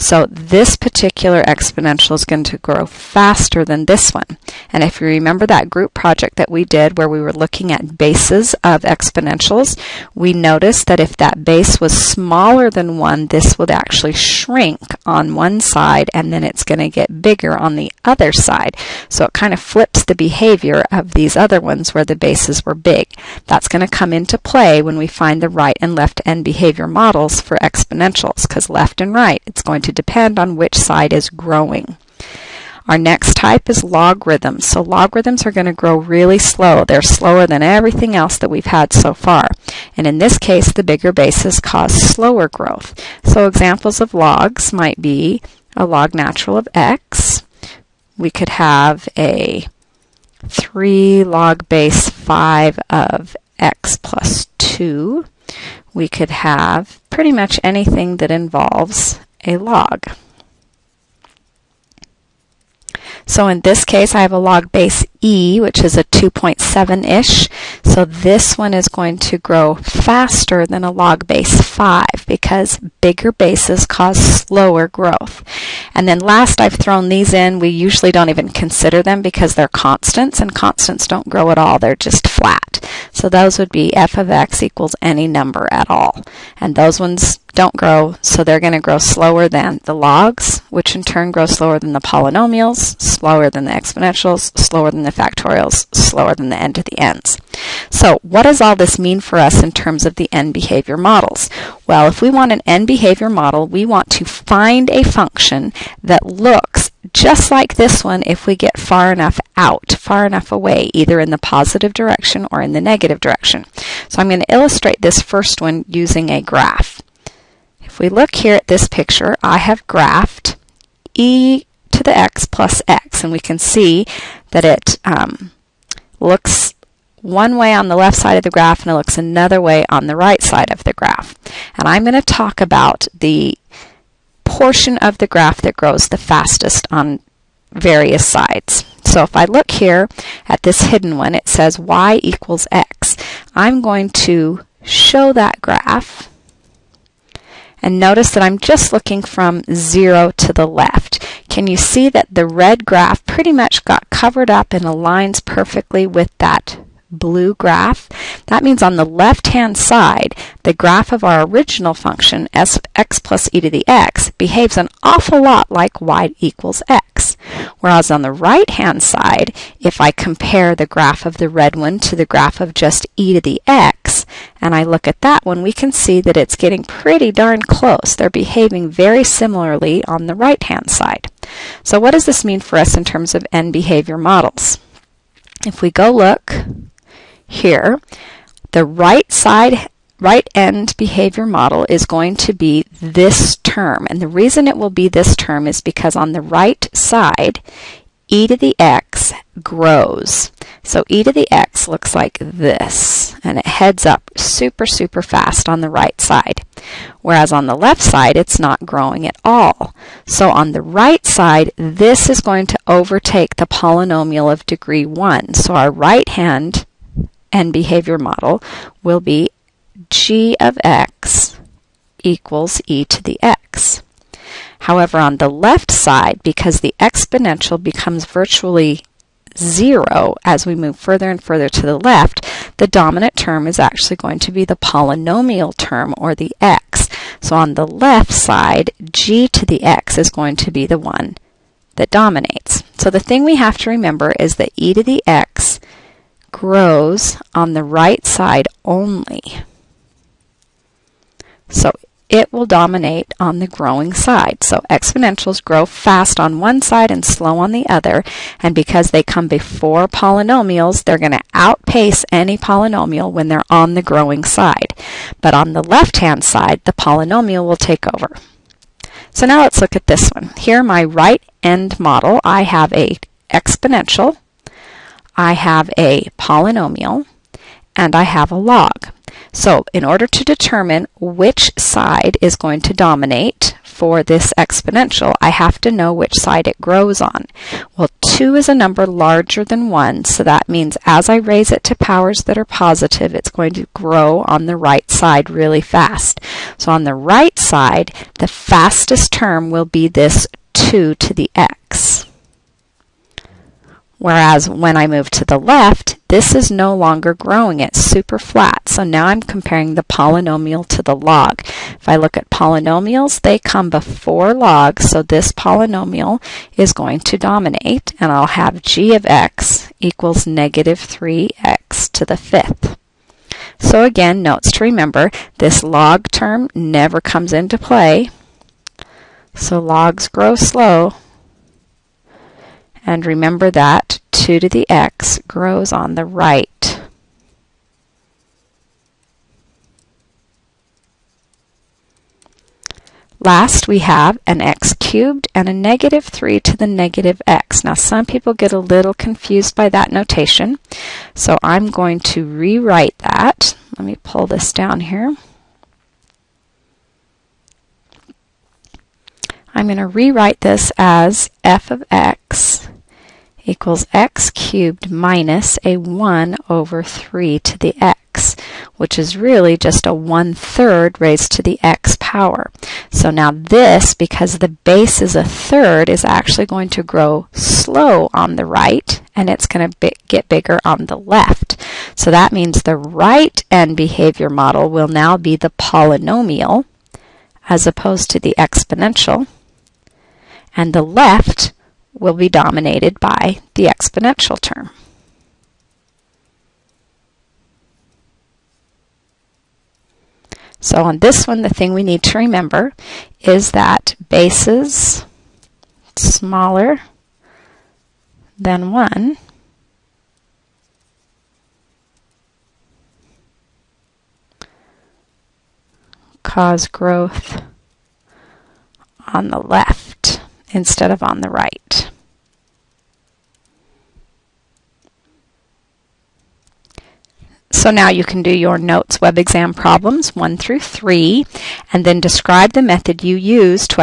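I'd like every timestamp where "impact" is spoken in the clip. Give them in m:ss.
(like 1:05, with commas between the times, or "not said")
not said.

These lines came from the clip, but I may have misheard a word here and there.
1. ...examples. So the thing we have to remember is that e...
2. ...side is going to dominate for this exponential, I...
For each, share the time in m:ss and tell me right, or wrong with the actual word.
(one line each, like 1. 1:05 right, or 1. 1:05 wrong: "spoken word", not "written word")
1. 4:02 wrong: "dominates", not "examples"
2. 4:41 right.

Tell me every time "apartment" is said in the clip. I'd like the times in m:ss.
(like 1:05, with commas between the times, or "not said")
not said.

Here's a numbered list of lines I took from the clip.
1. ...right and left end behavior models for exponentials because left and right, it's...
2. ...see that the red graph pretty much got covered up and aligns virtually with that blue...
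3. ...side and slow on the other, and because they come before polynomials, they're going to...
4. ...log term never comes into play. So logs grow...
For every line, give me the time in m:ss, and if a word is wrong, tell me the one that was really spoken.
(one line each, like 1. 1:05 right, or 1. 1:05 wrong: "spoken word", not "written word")
1. 0:25 right
2. 2:31 wrong: "perfectly", not "virtually"
3. 4:16 right
4. 5:25 right.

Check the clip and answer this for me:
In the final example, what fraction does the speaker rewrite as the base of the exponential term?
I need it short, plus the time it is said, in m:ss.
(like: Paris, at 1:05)
1/3, at 6:10.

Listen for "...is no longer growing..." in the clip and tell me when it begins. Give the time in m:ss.
5:06.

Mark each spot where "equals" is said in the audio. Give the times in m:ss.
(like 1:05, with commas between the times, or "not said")
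1:24, 2:22, 2:46, 3:42, 5:19, 6:03.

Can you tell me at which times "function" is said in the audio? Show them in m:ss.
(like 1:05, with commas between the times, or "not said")
1:45, 2:41.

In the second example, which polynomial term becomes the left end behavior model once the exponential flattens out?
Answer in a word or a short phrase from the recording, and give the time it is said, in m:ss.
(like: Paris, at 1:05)
-3x^5, at 5:20.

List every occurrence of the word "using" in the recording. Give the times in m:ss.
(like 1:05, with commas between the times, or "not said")
1:55.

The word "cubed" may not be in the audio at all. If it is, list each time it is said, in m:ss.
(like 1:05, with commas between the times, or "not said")
5:44, 6:04.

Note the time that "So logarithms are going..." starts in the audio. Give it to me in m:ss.
0:34.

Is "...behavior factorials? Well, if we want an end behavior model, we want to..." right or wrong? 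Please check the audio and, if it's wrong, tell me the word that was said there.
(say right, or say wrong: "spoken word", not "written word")
wrong: "models", not "factorials".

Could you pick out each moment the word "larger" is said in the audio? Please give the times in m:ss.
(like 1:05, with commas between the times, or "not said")
4:49.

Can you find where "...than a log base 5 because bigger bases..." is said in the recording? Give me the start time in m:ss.
1:10.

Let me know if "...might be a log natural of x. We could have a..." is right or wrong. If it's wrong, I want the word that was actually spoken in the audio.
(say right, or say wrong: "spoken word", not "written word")
right.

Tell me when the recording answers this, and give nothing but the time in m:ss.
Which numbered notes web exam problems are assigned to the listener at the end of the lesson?
7:10.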